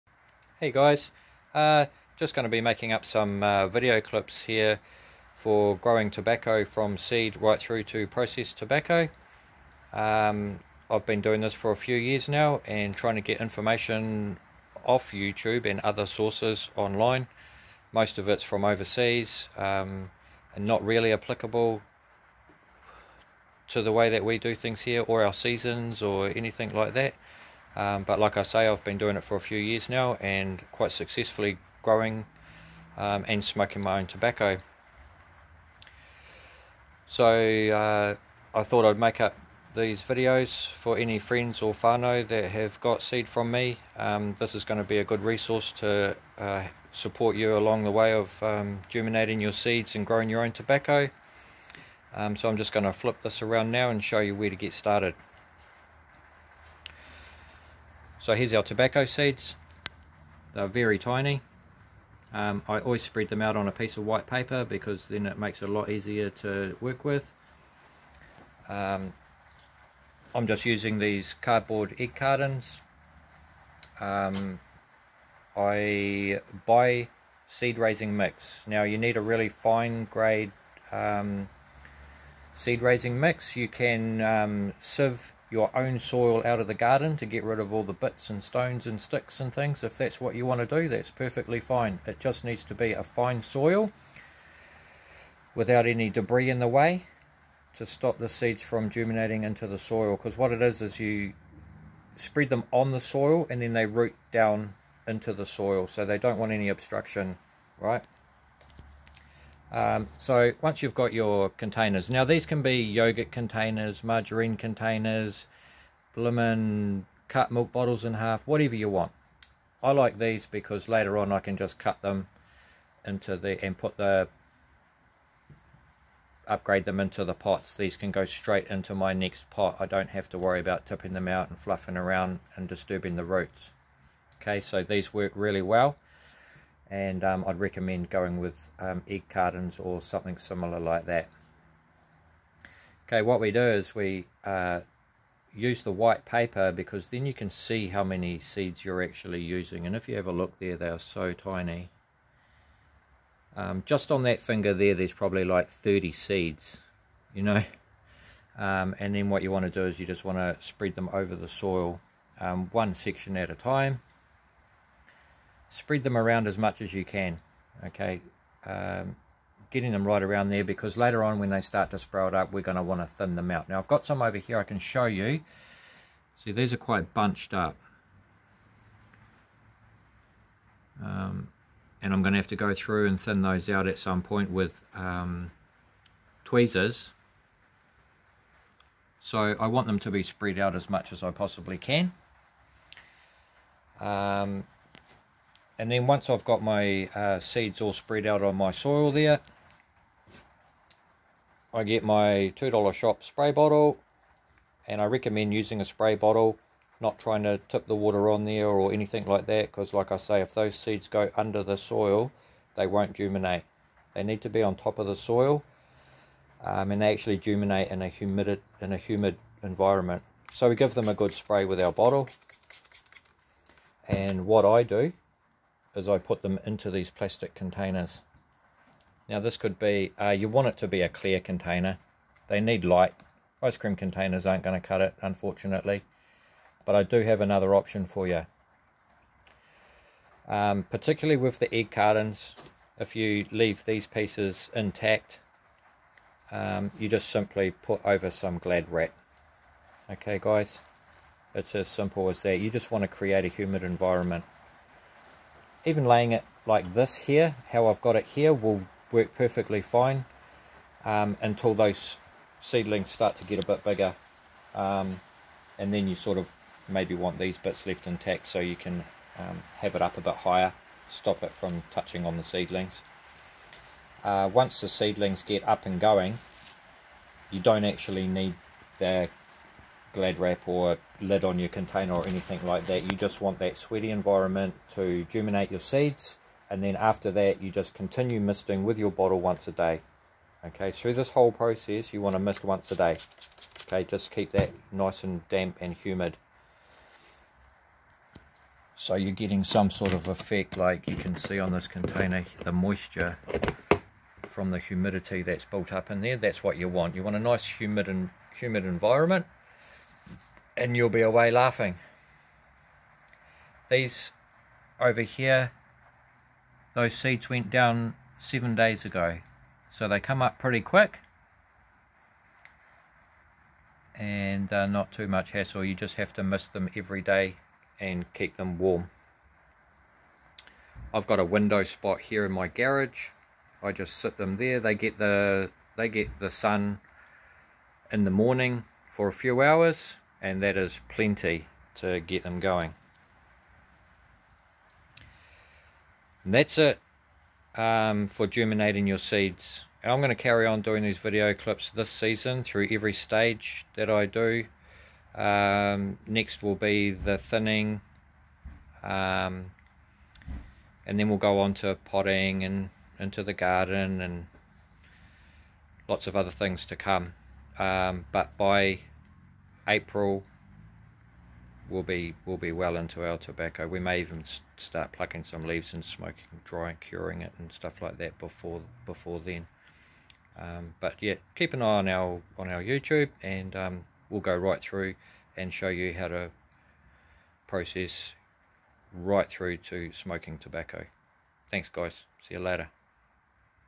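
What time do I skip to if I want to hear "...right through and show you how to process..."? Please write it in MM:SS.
06:24.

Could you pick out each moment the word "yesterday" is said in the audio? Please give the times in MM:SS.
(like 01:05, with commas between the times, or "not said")
not said.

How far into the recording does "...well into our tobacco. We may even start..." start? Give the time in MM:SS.
06:12.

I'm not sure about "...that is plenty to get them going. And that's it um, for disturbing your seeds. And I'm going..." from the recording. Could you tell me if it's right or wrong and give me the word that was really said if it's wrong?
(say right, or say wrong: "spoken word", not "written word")
wrong: "germinating", not "disturbing".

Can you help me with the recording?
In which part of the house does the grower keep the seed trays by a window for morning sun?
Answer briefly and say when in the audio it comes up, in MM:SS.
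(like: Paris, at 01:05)
garage, at 05:32.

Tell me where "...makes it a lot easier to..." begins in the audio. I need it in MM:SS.
01:05.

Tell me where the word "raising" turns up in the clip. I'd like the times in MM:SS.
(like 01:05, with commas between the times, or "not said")
01:17, 01:22.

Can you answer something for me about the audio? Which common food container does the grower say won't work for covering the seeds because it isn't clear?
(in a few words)
Ice cream containers.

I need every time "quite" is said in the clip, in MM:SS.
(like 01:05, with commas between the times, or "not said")
00:30, 02:56.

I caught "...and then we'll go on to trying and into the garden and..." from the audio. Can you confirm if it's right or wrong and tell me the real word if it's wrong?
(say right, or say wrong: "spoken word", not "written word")
wrong: "potting", not "trying".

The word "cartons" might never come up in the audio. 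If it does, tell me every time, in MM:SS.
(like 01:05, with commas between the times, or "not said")
01:12, 02:19, 04:01.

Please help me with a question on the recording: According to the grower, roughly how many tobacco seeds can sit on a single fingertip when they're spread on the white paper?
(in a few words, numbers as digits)
30.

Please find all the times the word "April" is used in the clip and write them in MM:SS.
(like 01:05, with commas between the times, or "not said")
06:09.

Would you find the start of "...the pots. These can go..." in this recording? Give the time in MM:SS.
02:07.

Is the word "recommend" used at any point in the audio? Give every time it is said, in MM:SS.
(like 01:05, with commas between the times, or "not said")
02:17, 03:25.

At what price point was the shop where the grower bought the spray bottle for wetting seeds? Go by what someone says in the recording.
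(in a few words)
$2.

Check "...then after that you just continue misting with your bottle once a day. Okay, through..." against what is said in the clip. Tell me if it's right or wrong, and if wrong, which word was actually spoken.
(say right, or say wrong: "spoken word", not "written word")
right.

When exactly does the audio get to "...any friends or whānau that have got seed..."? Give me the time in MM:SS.
00:40.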